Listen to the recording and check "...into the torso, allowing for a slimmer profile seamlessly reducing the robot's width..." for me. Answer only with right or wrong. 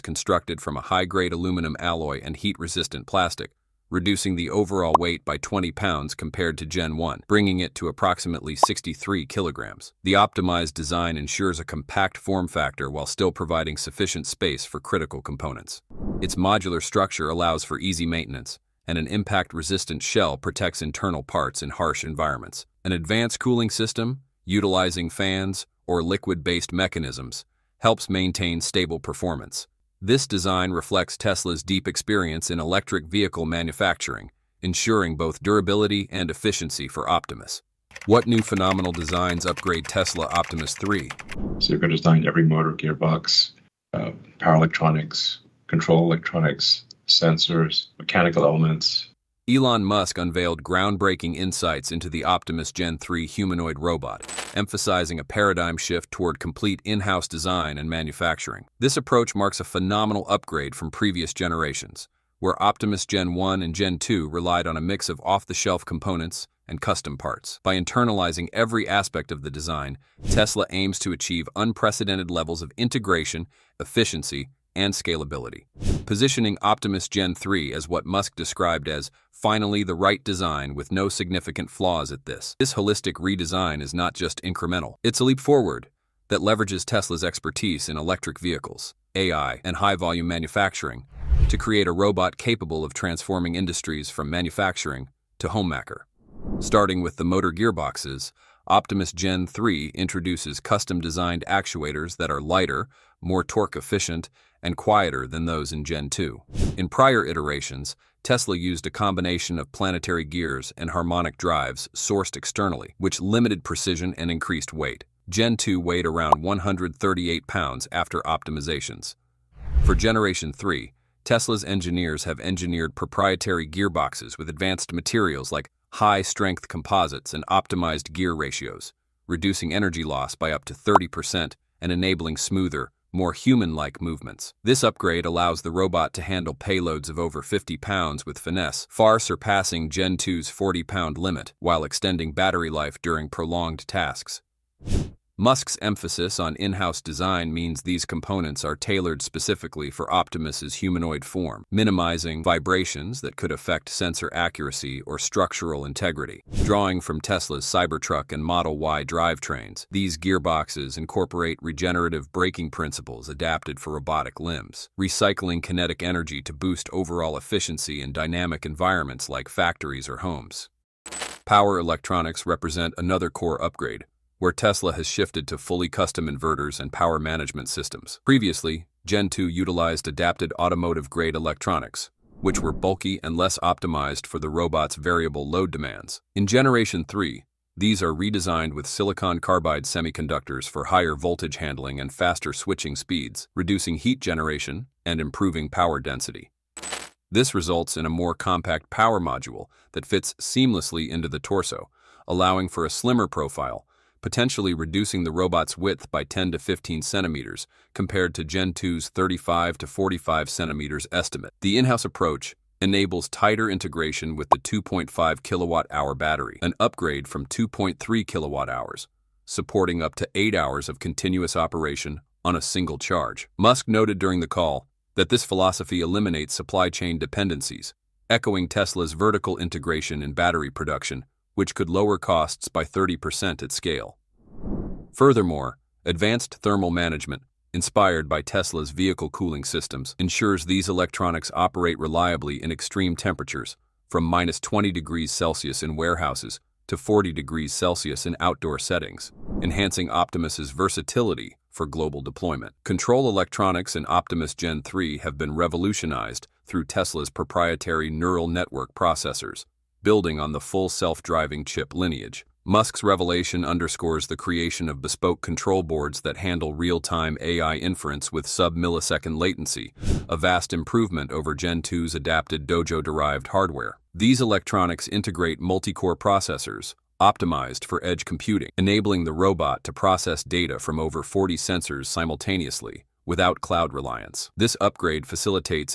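wrong.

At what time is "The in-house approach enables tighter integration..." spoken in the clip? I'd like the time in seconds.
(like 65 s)
211 s.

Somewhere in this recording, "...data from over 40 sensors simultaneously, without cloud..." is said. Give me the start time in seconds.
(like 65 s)
280 s.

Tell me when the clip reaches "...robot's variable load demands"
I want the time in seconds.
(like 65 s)
184 s.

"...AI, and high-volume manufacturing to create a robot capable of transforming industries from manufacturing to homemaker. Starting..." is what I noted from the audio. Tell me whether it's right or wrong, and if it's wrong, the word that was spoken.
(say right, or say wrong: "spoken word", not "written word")
right.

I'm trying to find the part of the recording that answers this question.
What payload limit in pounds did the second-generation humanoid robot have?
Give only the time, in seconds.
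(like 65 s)
140 s.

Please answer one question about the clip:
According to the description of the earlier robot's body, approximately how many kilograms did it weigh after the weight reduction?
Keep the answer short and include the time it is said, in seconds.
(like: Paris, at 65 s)
63 kilograms, at 8 s.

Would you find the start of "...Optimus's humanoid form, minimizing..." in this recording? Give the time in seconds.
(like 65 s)
150 s.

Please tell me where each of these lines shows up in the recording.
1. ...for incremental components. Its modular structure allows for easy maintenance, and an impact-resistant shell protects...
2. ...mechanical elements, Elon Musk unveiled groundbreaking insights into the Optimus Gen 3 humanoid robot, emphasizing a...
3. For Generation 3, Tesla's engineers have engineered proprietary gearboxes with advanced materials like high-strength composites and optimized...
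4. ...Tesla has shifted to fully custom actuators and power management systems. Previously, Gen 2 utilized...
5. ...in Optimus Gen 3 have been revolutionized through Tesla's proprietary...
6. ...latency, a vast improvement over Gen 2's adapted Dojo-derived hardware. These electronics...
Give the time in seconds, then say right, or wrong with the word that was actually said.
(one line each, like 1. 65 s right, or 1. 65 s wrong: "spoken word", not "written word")
1. 14 s wrong: "critical", not "incremental"
2. 47 s right
3. 119 s right
4. 174 s wrong: "inverters", not "actuators"
5. 253 s right
6. 269 s right.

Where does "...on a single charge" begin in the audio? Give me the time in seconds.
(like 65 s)
222 s.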